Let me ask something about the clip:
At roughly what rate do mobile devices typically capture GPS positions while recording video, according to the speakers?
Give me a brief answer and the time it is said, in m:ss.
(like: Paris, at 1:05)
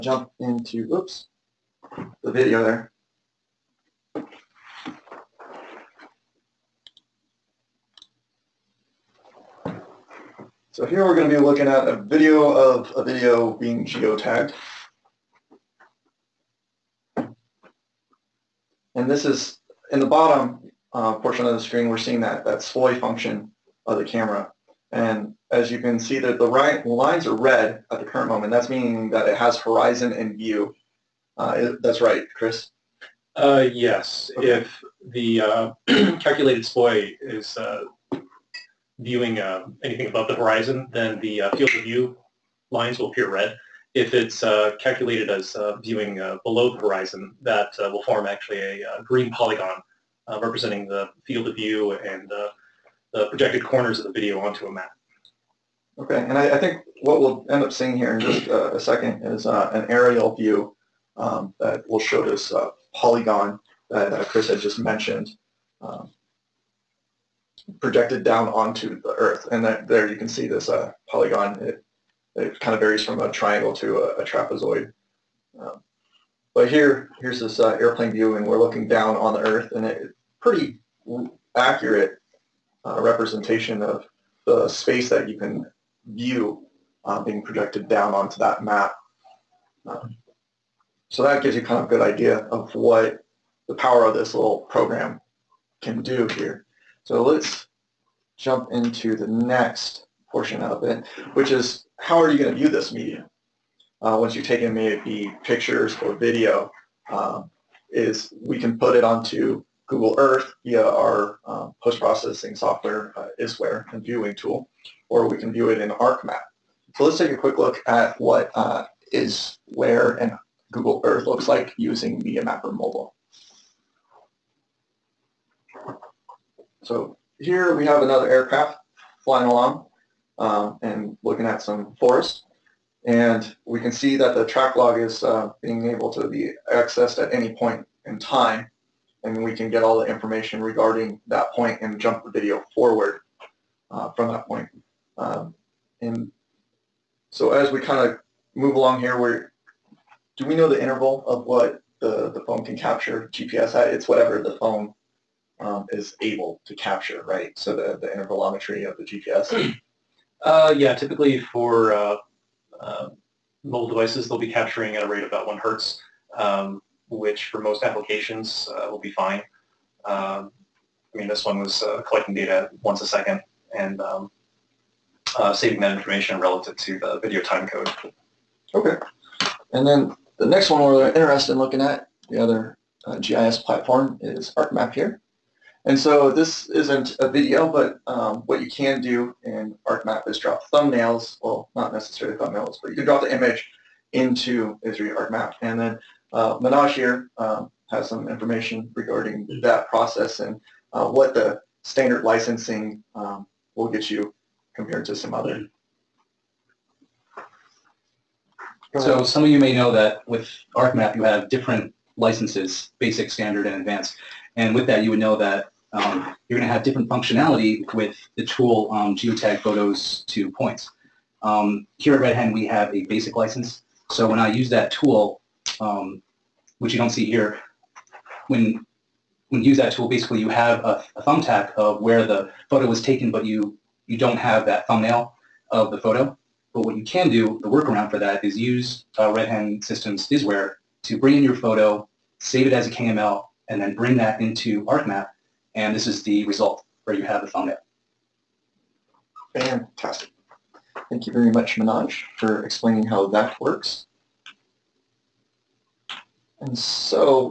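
1 hertz, at 2:45.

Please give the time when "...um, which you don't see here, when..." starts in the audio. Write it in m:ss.
3:45.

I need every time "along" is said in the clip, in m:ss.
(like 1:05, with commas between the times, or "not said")
2:09, 2:28.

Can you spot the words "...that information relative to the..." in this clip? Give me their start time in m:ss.
2:55.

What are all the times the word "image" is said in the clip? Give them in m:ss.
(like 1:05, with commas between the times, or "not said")
3:13.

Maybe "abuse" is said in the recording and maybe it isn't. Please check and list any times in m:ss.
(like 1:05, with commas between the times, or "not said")
not said.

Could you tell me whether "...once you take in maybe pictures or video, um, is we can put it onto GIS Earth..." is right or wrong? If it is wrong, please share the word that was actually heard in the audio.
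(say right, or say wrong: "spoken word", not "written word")
wrong: "Google", not "GIS".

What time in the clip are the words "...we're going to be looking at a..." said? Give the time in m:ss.
0:11.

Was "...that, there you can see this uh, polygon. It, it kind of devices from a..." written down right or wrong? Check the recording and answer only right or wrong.
wrong.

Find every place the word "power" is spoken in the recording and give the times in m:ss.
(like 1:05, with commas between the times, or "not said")
1:33.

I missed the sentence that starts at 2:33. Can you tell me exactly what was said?
It's whatever the phone um, is able to capture, right?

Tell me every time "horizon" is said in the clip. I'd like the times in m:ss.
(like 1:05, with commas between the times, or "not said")
0:29, 0:40, 0:46.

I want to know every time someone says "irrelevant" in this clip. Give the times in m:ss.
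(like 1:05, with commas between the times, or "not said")
not said.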